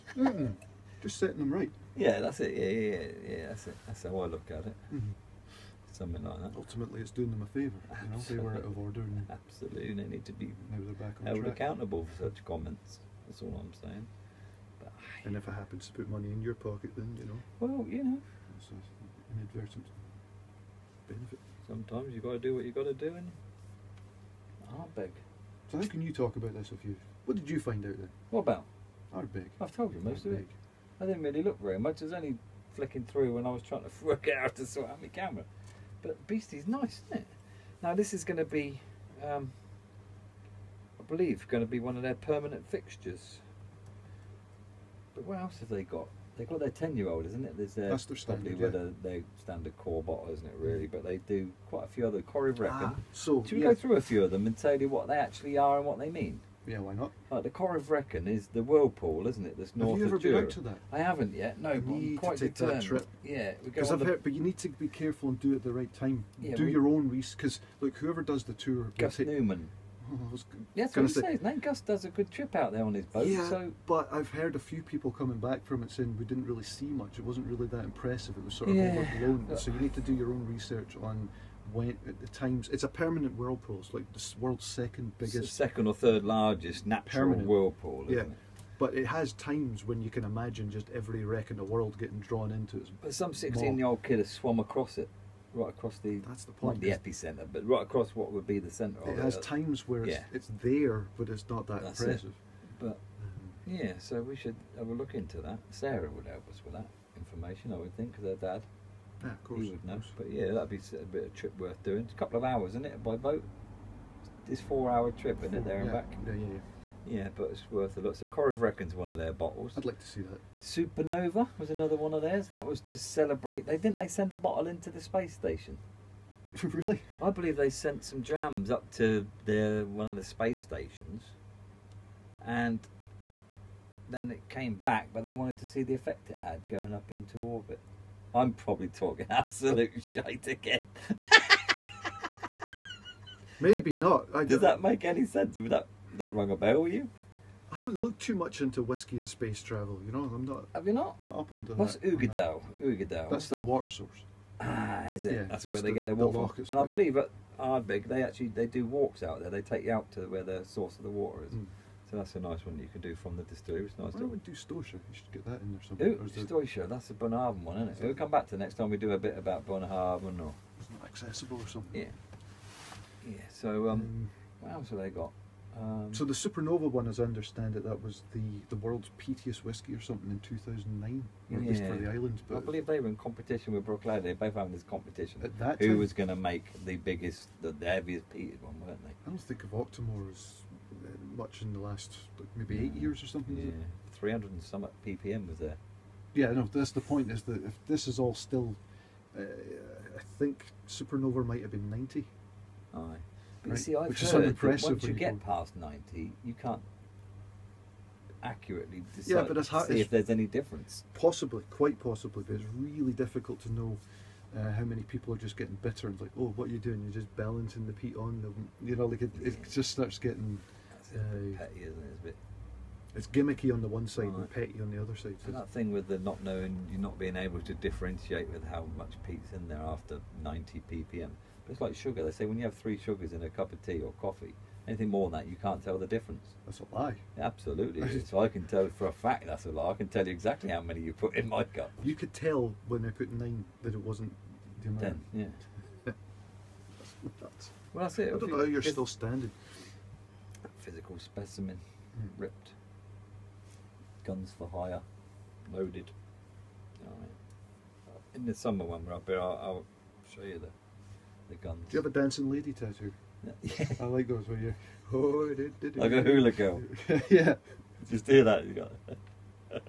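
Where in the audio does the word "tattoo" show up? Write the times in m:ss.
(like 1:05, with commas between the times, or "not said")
4:22.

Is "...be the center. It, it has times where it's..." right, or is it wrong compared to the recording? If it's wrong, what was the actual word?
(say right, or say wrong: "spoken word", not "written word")
right.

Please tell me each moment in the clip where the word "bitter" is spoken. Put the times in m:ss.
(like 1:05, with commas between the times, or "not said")
3:35.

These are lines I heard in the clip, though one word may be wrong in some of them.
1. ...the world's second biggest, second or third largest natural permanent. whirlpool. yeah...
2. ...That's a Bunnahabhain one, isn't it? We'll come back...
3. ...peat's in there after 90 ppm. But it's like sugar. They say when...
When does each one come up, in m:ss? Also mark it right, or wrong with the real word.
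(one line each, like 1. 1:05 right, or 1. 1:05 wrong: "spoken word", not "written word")
1. 1:24 right
2. 2:46 right
3. 3:49 right.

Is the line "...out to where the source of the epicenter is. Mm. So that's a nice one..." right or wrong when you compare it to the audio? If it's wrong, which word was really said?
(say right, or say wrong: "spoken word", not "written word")
wrong: "water", not "epicenter".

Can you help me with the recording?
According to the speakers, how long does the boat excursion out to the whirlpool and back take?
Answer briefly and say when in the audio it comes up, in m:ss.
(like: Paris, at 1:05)
4 hours, at 1:54.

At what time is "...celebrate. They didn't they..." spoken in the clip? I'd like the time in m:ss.
2:02.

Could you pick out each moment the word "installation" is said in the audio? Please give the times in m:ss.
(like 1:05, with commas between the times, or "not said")
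not said.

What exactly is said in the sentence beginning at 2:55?
Um, so the Supernova one, as I understand it, that was the the world's peatiest whiskey or something in 2009, yeah.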